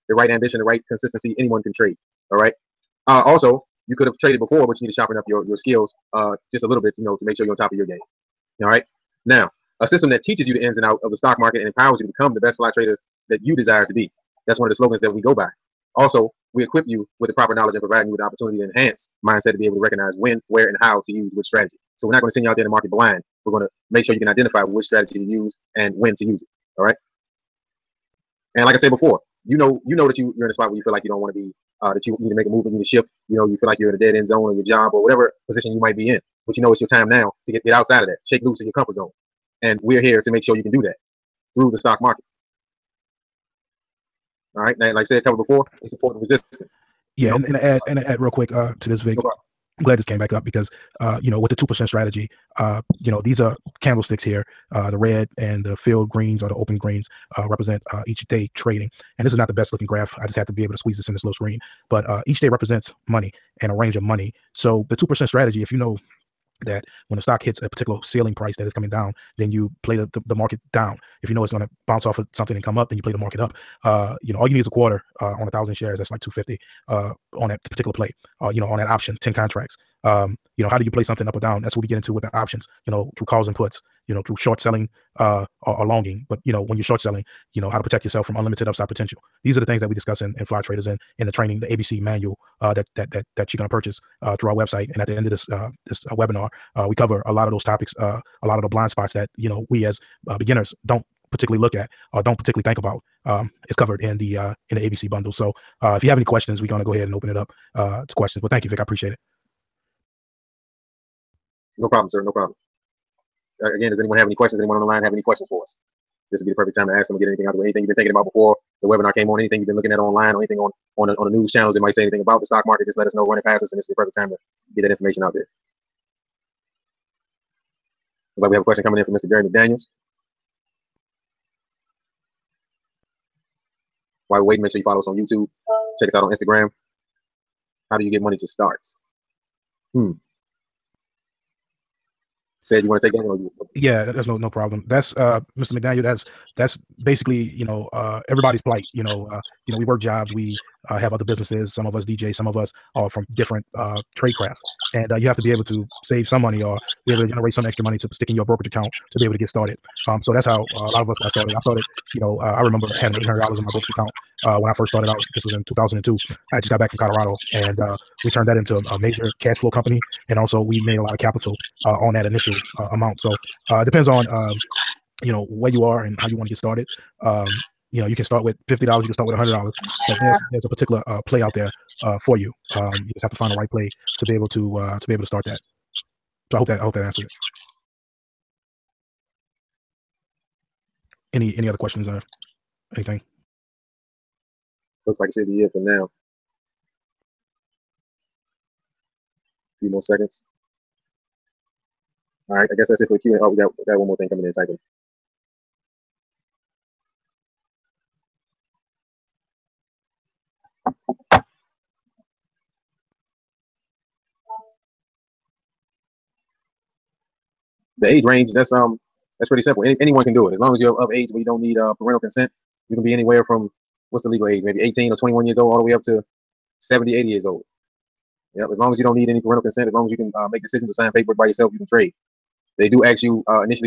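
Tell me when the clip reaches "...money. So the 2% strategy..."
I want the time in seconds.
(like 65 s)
64 s.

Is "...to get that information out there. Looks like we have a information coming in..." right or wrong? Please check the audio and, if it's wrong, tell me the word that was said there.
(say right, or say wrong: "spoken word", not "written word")
wrong: "question", not "information".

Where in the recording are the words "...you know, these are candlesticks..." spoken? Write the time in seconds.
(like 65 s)
52 s.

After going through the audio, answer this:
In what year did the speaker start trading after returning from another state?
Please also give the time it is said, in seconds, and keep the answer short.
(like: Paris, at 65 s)
2002, at 165 s.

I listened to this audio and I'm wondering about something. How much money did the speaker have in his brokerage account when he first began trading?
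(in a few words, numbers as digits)
$800.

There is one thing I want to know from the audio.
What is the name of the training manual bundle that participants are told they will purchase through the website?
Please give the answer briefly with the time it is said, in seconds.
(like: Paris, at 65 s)
ABC manual, at 91 s.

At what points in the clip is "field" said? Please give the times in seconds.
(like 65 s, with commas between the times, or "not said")
55 s.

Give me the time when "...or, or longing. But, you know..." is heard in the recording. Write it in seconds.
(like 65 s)
85 s.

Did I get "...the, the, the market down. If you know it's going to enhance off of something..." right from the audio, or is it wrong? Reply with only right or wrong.
wrong.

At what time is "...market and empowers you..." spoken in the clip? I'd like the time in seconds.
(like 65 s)
11 s.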